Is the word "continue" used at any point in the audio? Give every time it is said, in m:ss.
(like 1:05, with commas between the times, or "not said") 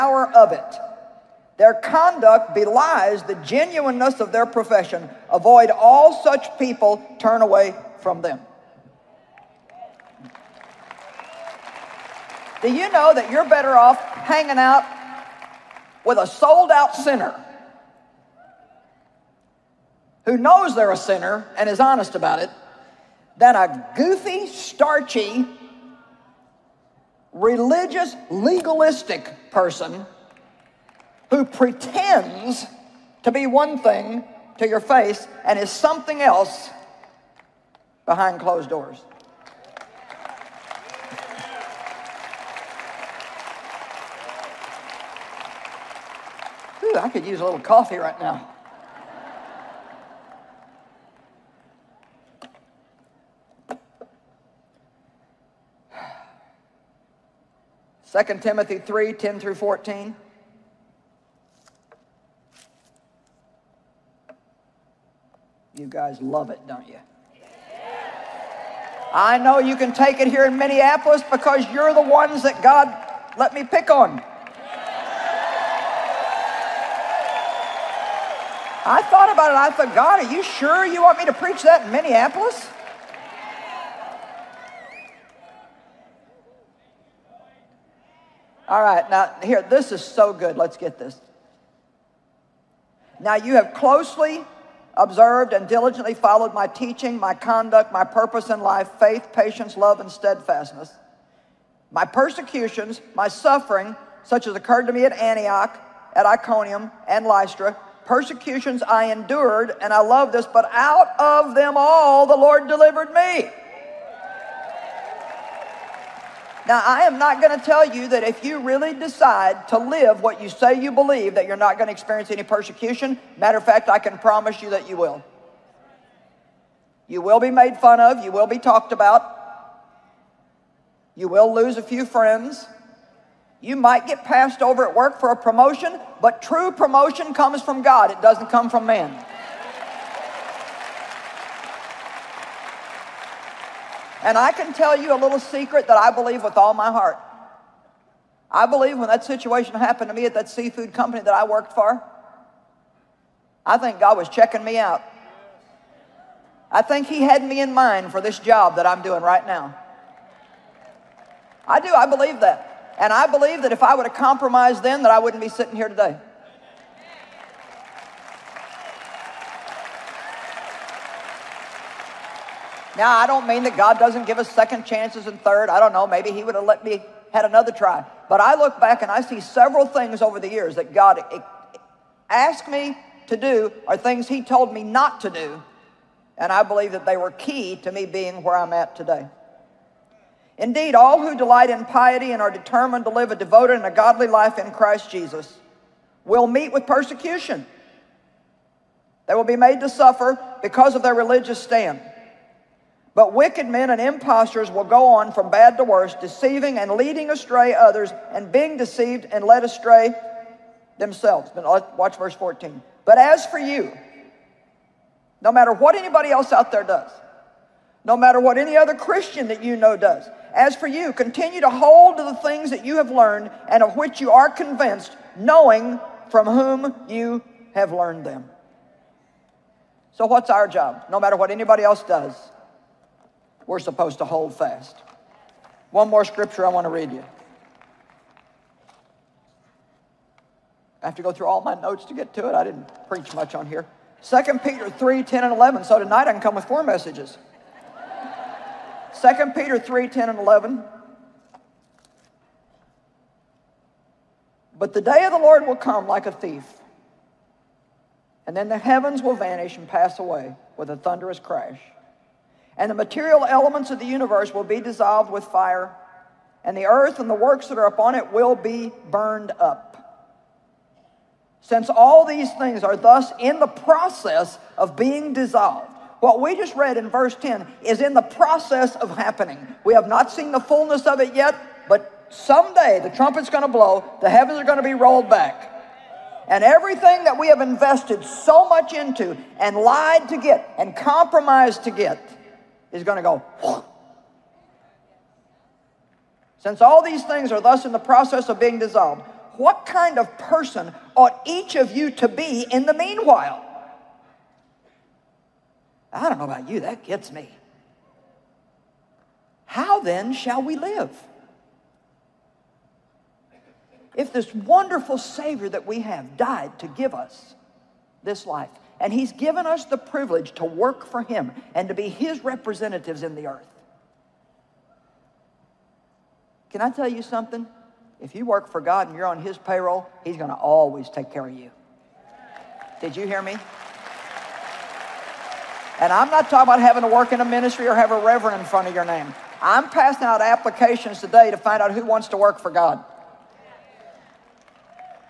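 3:41.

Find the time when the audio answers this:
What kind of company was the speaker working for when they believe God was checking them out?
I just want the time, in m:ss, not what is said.
2:30.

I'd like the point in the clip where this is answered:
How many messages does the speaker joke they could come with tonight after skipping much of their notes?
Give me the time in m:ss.
4:06.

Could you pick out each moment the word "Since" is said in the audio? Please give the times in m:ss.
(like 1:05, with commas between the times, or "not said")
4:31, 4:56.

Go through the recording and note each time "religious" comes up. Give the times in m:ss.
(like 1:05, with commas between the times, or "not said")
0:27, 3:21.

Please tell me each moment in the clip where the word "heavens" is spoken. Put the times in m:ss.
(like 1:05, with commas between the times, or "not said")
4:18, 4:44.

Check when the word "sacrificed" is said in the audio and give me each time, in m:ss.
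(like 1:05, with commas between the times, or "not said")
not said.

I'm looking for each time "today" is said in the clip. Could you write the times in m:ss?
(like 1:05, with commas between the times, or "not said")
2:45, 3:08, 5:41.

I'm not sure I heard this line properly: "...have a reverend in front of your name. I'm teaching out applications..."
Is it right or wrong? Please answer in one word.
wrong.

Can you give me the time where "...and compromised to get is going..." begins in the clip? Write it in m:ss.
4:50.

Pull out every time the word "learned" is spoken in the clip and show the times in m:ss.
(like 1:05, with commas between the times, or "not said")
3:43, 3:47.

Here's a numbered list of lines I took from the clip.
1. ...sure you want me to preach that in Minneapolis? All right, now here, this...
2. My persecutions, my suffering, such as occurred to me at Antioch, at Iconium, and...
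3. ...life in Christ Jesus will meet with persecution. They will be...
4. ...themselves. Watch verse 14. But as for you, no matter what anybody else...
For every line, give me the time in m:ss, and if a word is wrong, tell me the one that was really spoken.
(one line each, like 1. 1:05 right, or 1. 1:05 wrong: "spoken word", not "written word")
1. 1:20 right
2. 1:41 right
3. 3:14 right
4. 3:30 right.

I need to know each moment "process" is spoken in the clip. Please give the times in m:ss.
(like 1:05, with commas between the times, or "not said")
4:33, 4:38, 4:57.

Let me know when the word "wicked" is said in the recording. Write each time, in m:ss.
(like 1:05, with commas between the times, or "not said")
3:23.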